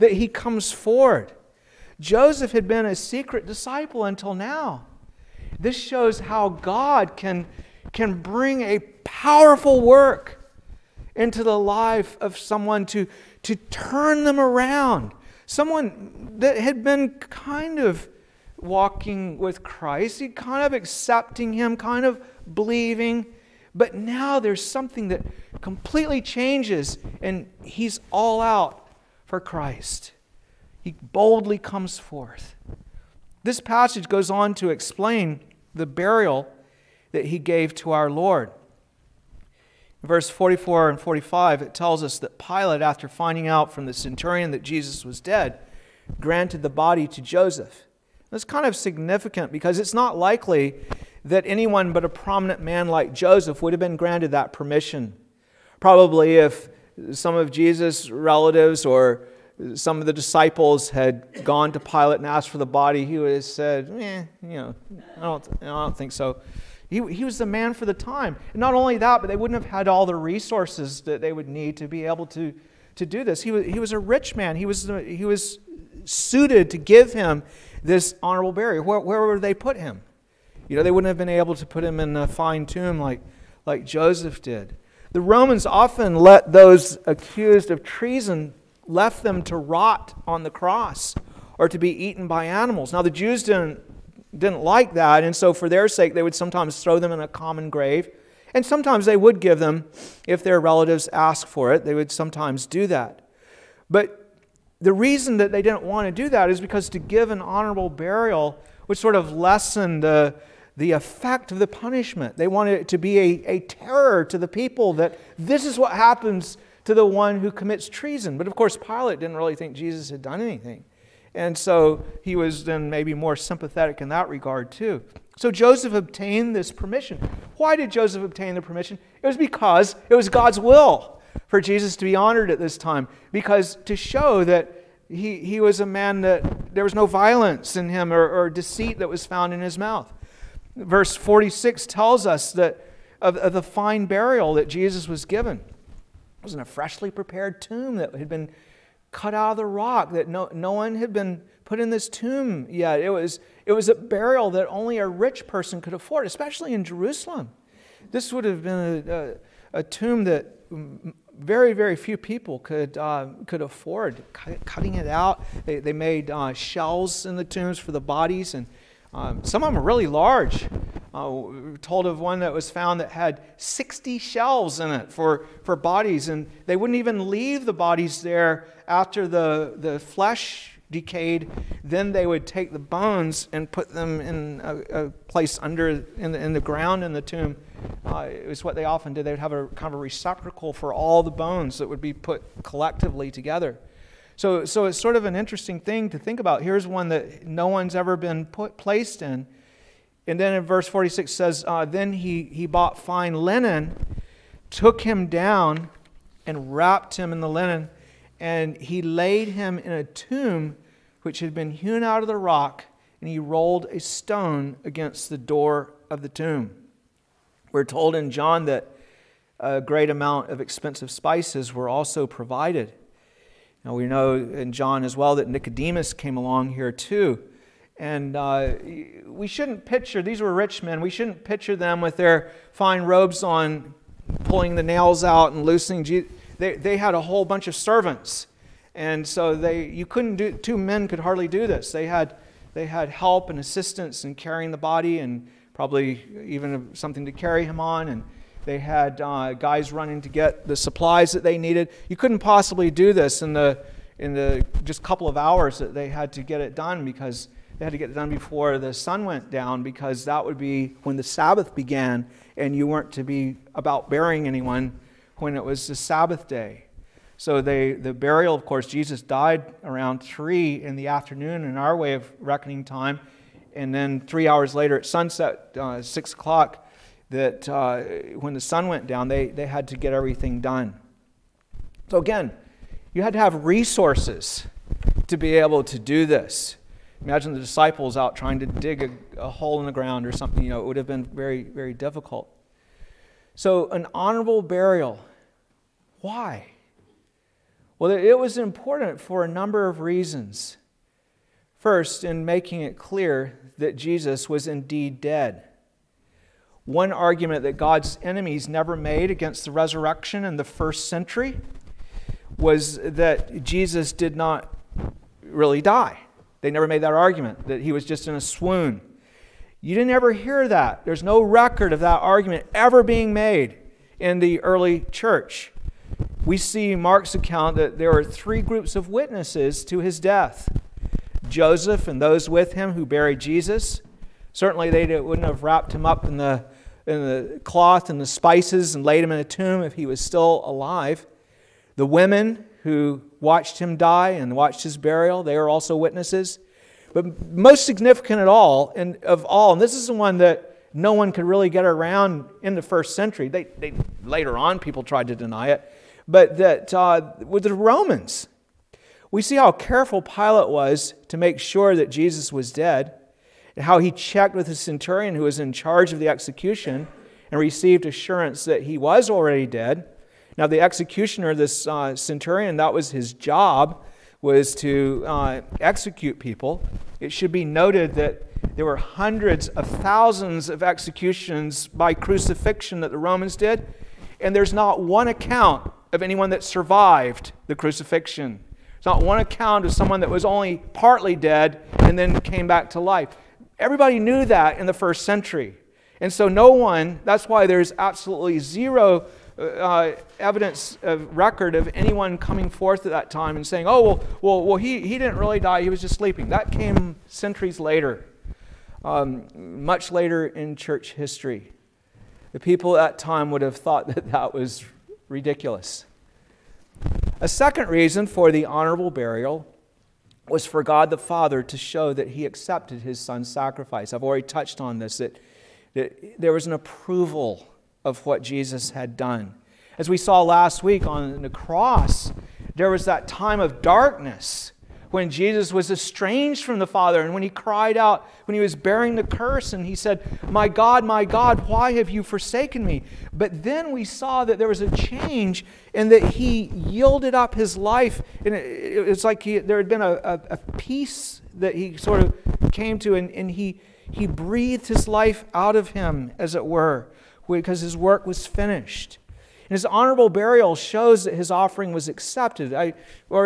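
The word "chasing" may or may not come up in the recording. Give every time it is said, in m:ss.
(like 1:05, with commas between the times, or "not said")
not said.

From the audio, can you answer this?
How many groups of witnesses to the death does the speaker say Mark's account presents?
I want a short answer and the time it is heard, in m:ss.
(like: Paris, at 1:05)
3, at 5:28.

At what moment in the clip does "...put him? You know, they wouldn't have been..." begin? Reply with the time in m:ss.
1:19.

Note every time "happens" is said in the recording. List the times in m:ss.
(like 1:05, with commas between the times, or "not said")
1:55.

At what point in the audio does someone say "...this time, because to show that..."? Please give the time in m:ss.
2:12.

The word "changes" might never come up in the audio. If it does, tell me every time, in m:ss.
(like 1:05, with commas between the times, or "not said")
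0:26, 7:24.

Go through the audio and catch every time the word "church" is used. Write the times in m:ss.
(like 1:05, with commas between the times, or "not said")
5:25, 6:50.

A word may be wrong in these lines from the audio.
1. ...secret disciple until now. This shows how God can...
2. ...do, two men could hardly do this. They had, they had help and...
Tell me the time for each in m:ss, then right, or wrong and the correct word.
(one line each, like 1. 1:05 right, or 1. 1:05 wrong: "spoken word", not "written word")
1. 0:02 right
2. 4:00 right.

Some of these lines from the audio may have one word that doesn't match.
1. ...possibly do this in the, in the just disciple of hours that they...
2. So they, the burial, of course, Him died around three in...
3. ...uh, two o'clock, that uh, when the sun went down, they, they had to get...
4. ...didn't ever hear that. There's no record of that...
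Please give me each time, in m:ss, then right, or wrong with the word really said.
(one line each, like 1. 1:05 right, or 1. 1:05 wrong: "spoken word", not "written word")
1. 4:12 wrong: "couple", not "disciple"
2. 4:27 wrong: "Jesus", not "Him"
3. 4:35 wrong: "six", not "two"
4. 5:19 right.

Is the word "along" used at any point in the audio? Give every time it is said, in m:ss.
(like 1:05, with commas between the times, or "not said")
3:46.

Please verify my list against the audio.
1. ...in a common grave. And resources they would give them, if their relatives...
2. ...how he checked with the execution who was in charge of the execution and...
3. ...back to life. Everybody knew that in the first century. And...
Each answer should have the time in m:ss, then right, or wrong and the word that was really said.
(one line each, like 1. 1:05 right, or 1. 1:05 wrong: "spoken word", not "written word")
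1. 1:37 wrong: "sometimes", not "resources"
2. 6:03 wrong: "centurion", not "execution"
3. 6:32 right.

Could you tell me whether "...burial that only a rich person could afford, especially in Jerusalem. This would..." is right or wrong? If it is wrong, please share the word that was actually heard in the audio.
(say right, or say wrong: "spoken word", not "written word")
right.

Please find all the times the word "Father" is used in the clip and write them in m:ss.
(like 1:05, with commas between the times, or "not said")
7:01, 7:16.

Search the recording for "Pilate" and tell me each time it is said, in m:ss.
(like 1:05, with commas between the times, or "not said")
0:42, 1:01, 1:58, 6:00.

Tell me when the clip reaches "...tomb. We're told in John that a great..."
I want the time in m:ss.
3:36.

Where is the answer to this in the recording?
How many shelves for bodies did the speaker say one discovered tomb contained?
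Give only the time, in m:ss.
2:53.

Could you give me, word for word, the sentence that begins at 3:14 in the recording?
So, so it's sort of an interesting thing to think about.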